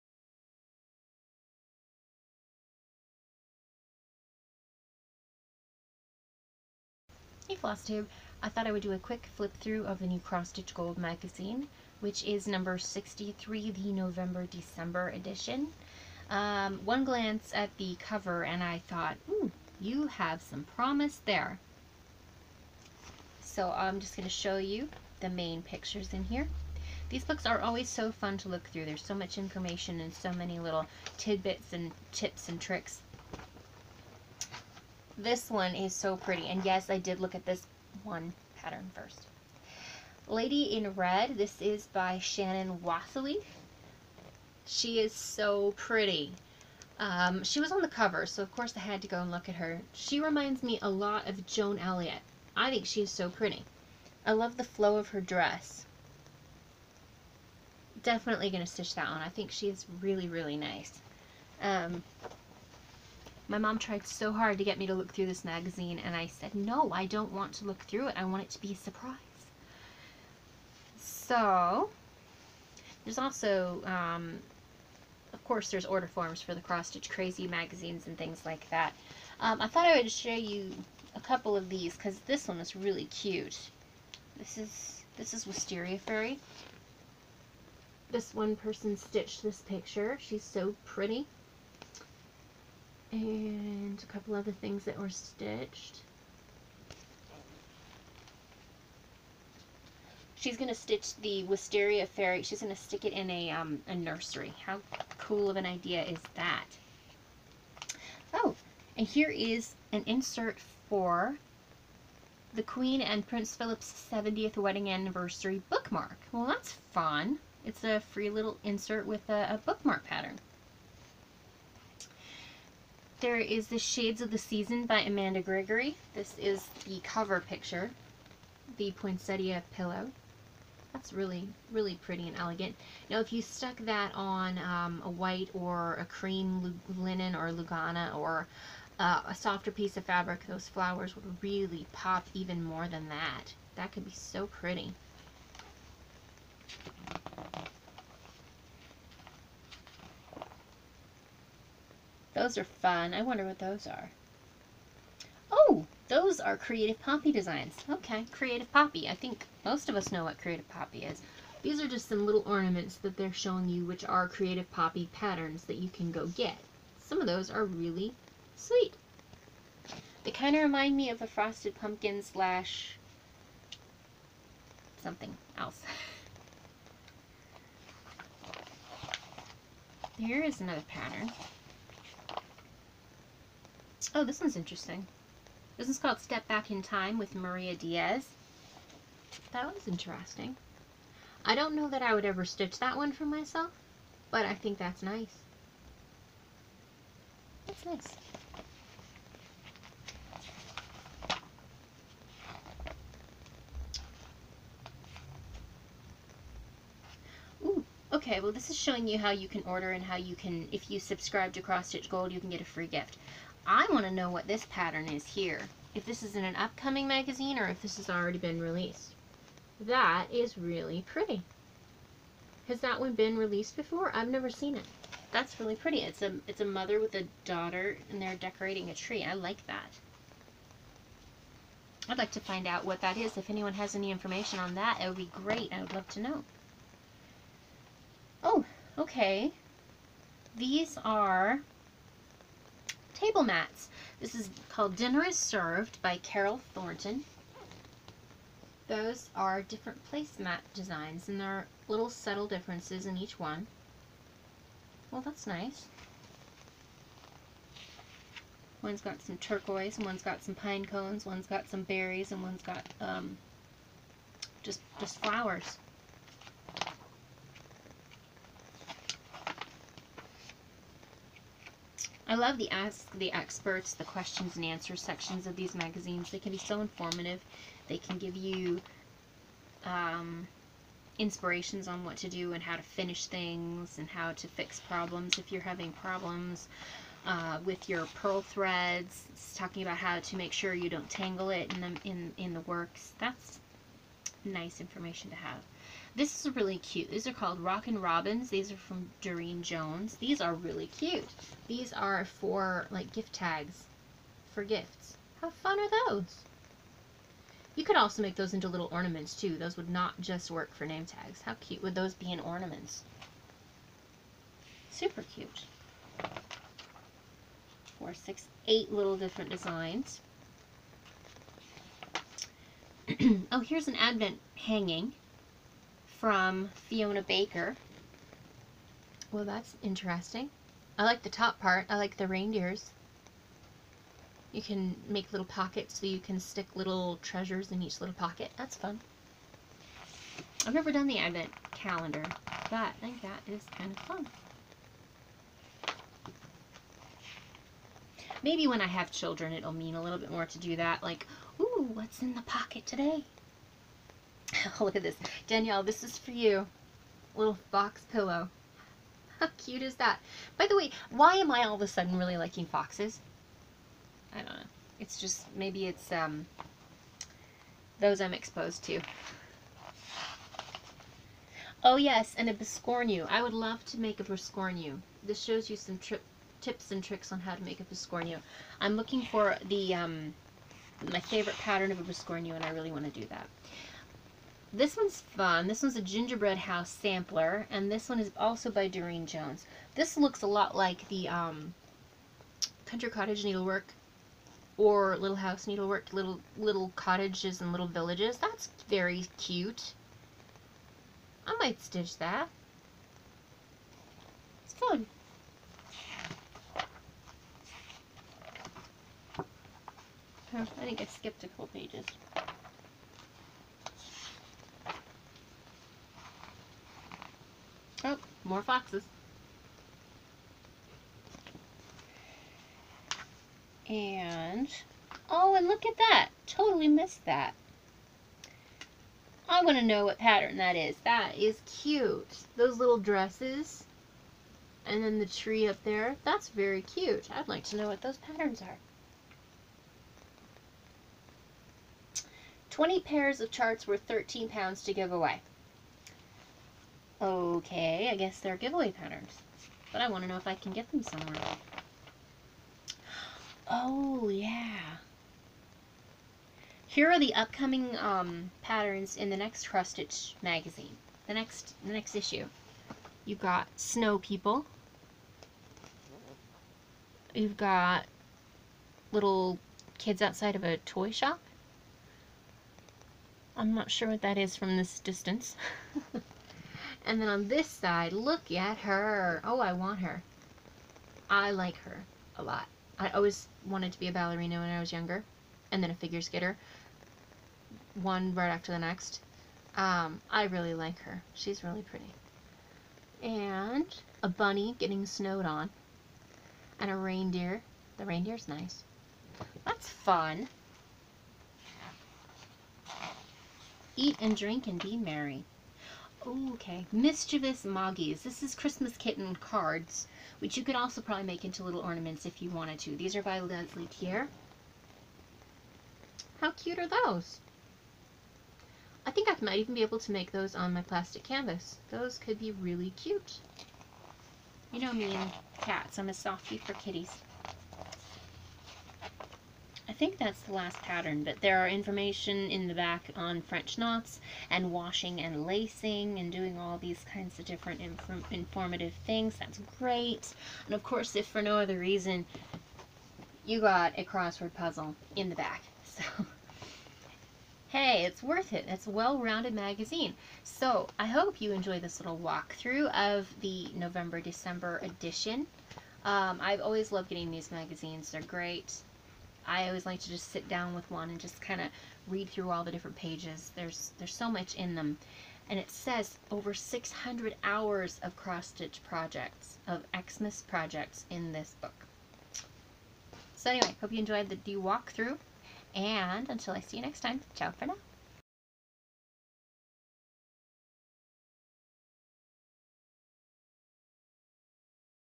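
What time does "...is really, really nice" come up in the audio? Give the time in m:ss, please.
0:59.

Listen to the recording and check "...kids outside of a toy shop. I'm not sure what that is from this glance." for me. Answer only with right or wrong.
wrong.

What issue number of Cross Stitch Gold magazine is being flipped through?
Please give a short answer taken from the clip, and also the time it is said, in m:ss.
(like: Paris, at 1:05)
63, at 0:12.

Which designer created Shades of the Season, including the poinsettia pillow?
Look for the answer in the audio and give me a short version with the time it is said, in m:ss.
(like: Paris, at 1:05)
Amanda Gregory, at 2:05.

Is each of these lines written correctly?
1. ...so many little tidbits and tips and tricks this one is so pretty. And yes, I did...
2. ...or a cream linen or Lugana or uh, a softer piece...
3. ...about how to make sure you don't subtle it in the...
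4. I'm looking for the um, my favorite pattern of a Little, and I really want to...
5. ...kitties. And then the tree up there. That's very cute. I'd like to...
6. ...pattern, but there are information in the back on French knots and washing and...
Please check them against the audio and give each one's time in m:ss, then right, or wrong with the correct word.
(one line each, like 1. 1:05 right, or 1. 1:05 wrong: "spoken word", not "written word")
1. 0:30 right
2. 2:15 right
3. 4:49 wrong: "tangle", not "subtle"
4. 6:18 wrong: "Biscornu", not "Little"
5. 7:12 wrong: "dresses", not "kitties"
6. 8:50 right.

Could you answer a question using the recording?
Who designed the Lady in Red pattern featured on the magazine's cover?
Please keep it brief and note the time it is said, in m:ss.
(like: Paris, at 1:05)
Shannon Wathley, at 0:42.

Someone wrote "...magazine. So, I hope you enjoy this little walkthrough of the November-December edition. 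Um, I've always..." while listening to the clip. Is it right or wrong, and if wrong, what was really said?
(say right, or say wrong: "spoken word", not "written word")
right.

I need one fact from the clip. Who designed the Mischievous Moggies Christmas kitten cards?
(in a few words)
Lesley Teare.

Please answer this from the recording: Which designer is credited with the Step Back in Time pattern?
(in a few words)
Maria Diaz.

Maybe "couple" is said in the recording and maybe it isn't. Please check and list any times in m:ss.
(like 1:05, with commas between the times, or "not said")
1:21, 1:34, 6:51.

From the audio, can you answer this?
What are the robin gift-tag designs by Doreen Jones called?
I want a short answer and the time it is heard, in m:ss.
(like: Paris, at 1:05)
Rockin' Robins, at 4:57.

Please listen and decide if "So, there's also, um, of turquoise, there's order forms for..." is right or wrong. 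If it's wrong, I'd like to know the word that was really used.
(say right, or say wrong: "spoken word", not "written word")
wrong: "course", not "turquoise".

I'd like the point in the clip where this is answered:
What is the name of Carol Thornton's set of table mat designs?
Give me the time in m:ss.
4:04.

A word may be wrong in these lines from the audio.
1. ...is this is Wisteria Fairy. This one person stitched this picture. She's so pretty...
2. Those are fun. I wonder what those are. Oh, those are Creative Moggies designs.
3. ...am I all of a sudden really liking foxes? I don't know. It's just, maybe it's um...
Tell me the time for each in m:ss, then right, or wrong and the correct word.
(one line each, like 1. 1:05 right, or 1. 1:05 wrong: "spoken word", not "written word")
1. 1:24 right
2. 2:32 wrong: "Poppy", not "Moggies"
3. 6:01 right.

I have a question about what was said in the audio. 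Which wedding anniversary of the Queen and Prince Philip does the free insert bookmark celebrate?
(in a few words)
70th.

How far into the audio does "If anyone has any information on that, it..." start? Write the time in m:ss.
3:53.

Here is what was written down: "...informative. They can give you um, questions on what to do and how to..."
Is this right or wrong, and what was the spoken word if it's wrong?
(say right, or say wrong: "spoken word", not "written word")
wrong: "inspirations", not "questions".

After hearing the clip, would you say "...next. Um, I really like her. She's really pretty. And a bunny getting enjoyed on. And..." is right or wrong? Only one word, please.
wrong.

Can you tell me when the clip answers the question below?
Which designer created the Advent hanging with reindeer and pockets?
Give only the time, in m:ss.
5:26.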